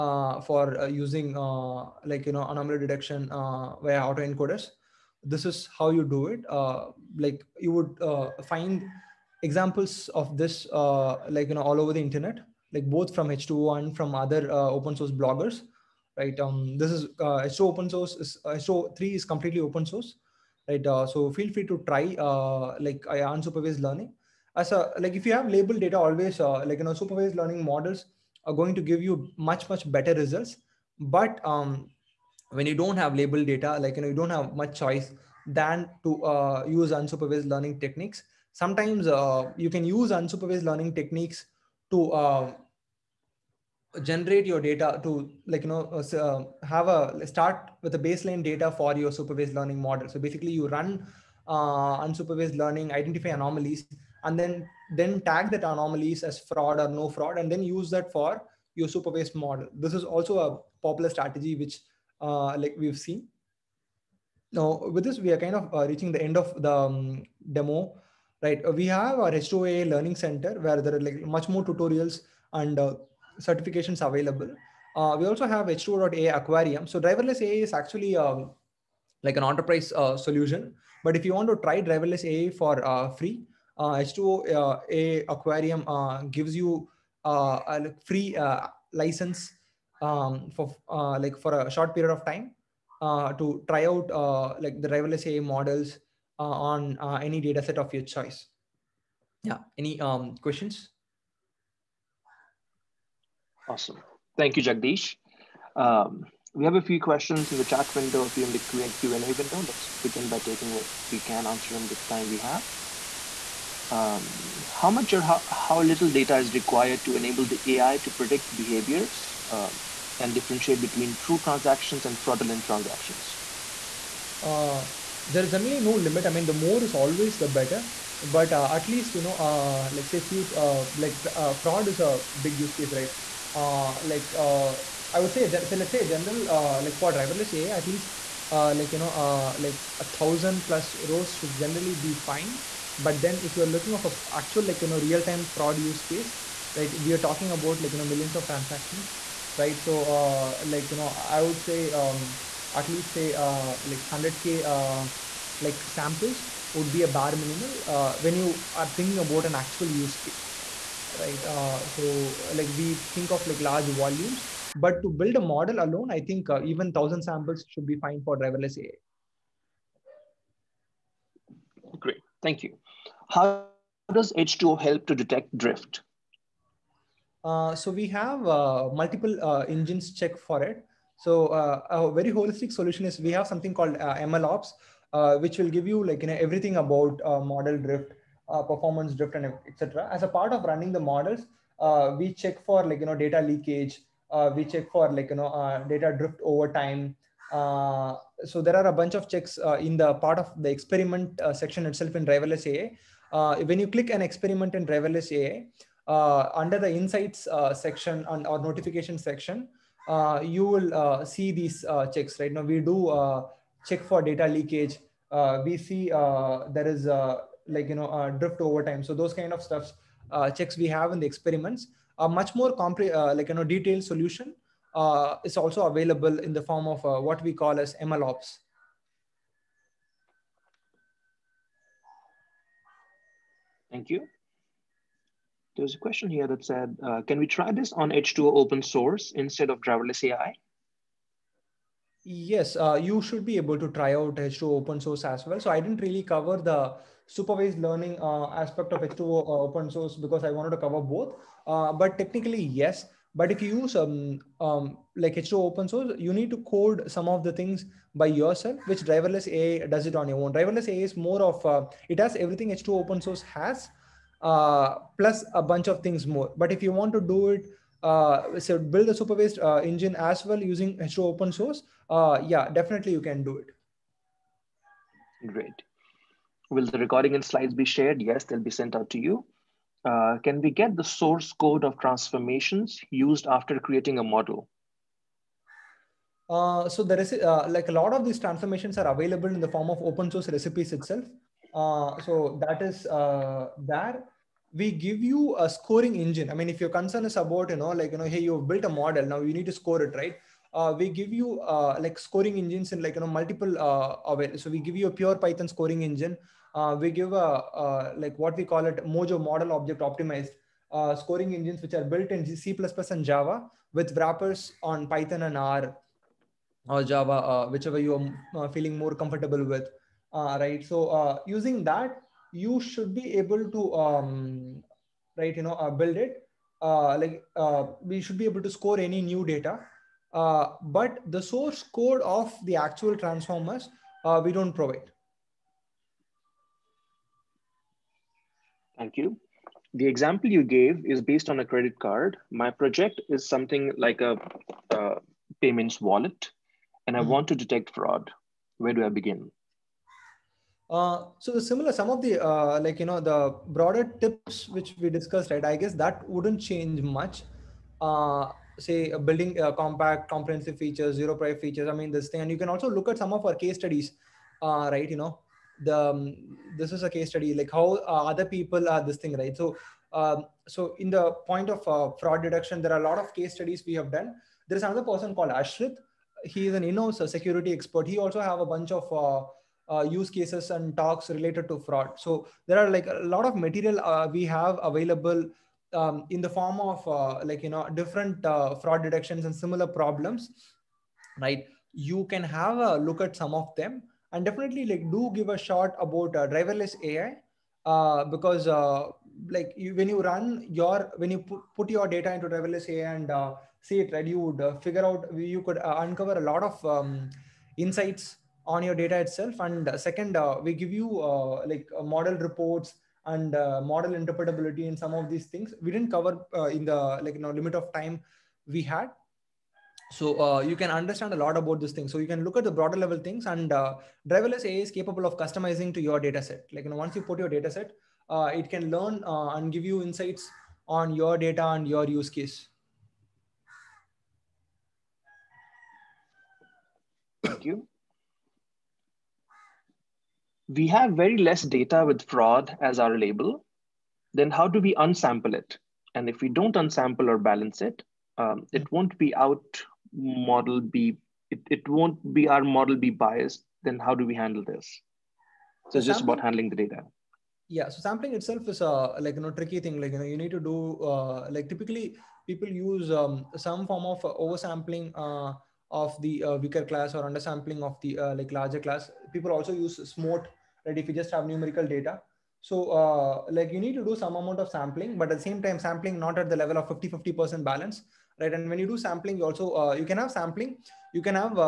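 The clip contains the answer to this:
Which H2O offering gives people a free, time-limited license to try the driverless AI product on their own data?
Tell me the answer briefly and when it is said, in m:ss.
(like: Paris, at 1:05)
H2O.ai Aquarium, at 1:15.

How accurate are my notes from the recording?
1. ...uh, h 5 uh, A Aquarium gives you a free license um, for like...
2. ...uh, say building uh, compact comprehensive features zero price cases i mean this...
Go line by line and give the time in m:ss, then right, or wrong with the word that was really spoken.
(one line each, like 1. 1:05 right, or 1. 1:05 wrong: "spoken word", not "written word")
1. 1:23 wrong: "2", not "5"
2. 5:57 wrong: "features", not "cases".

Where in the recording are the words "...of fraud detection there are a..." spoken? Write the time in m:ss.
6:11.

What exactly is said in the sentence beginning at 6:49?
And uh, second, uh, we give you uh, like model reports and model interpretability and some of these things.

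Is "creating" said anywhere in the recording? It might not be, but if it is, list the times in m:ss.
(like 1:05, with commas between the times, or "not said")
4:43.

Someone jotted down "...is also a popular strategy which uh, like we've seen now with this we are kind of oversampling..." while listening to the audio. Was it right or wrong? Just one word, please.
wrong.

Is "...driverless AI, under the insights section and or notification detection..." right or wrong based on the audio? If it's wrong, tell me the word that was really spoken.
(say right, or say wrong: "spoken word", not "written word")
wrong: "section", not "detection".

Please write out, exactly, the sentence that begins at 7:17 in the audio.
Thank you we have very less data with fraud as our label, then how do we unsample it?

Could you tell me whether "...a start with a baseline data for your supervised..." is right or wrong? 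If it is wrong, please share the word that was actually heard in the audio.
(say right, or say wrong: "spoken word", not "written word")
right.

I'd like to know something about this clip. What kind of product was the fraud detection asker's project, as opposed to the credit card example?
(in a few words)
payments wallet.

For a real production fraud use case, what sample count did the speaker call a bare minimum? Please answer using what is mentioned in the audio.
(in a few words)
100k.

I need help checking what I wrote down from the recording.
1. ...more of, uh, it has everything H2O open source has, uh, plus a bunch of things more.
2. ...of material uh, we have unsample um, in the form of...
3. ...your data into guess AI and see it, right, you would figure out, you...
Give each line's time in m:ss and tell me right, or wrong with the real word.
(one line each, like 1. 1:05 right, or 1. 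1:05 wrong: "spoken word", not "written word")
1. 4:21 right
2. 6:23 wrong: "available", not "unsample"
3. 6:41 wrong: "driverless", not "guess".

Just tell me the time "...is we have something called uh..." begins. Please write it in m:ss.
3:03.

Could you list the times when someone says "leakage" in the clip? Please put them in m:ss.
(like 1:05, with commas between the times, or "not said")
3:13, 3:34.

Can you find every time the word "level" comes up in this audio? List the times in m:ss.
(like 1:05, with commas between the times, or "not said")
7:02, 7:56.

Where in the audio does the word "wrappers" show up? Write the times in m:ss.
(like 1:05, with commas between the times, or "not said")
5:14.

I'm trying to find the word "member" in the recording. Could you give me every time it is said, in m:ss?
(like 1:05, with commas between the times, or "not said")
not said.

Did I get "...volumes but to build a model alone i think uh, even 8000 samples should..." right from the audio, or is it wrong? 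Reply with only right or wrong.
wrong.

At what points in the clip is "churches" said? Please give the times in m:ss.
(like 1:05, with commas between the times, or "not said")
not said.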